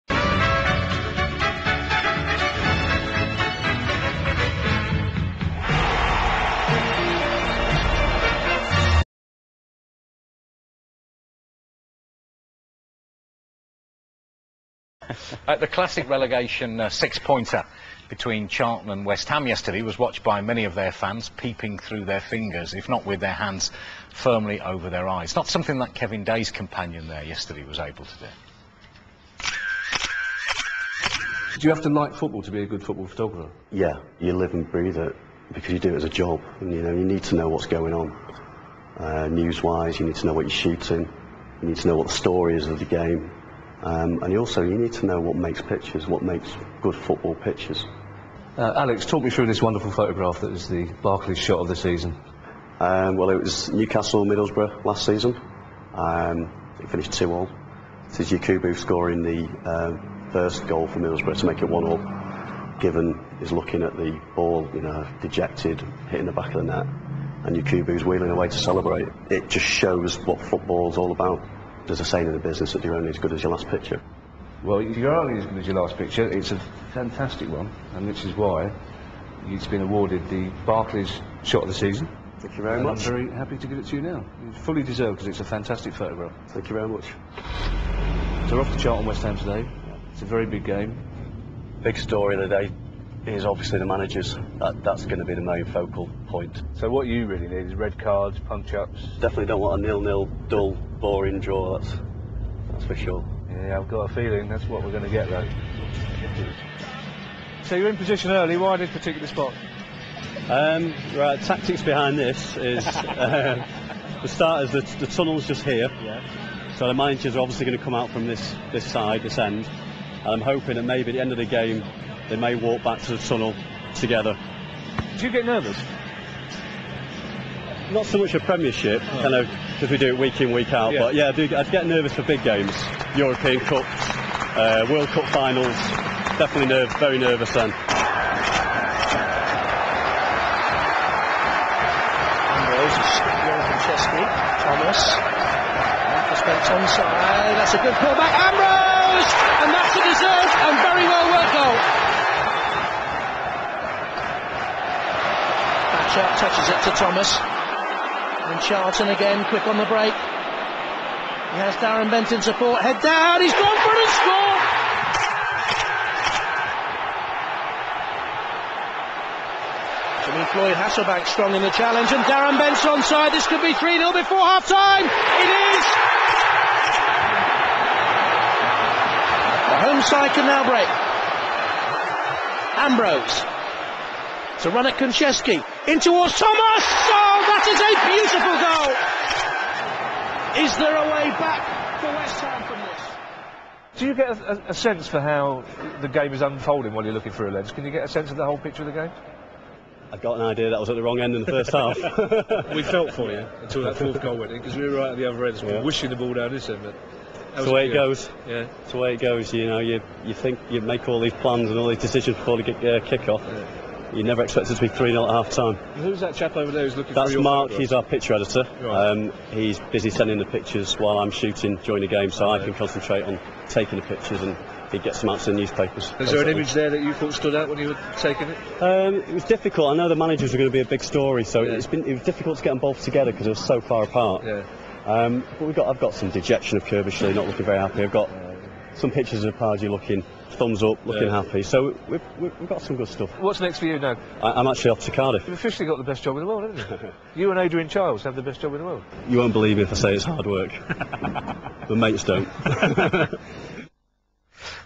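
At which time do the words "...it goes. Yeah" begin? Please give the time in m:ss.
3:27.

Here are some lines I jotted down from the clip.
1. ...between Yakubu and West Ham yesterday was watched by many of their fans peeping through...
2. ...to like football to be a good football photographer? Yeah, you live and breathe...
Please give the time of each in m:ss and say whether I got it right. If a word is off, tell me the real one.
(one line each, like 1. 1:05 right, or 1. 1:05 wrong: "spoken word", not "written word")
1. 0:18 wrong: "Charlton", not "Yakubu"
2. 0:31 right.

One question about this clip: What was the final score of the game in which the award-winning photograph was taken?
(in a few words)
2-2.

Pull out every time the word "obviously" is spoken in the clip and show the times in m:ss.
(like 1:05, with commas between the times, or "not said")
1:33, 1:57.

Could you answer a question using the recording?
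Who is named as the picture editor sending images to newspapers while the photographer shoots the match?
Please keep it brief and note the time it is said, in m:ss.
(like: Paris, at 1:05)
Mark, at 3:37.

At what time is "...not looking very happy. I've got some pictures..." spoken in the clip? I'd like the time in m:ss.
3:57.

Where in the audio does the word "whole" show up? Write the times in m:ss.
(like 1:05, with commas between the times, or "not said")
3:18.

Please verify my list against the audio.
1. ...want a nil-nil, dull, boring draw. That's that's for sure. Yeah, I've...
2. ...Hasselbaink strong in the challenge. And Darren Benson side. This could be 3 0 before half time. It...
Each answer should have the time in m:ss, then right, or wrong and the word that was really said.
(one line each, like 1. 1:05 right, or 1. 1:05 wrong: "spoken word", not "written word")
1. 1:39 right
2. 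2:50 right.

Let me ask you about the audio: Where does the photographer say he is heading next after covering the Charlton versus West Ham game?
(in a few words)
Cardiff.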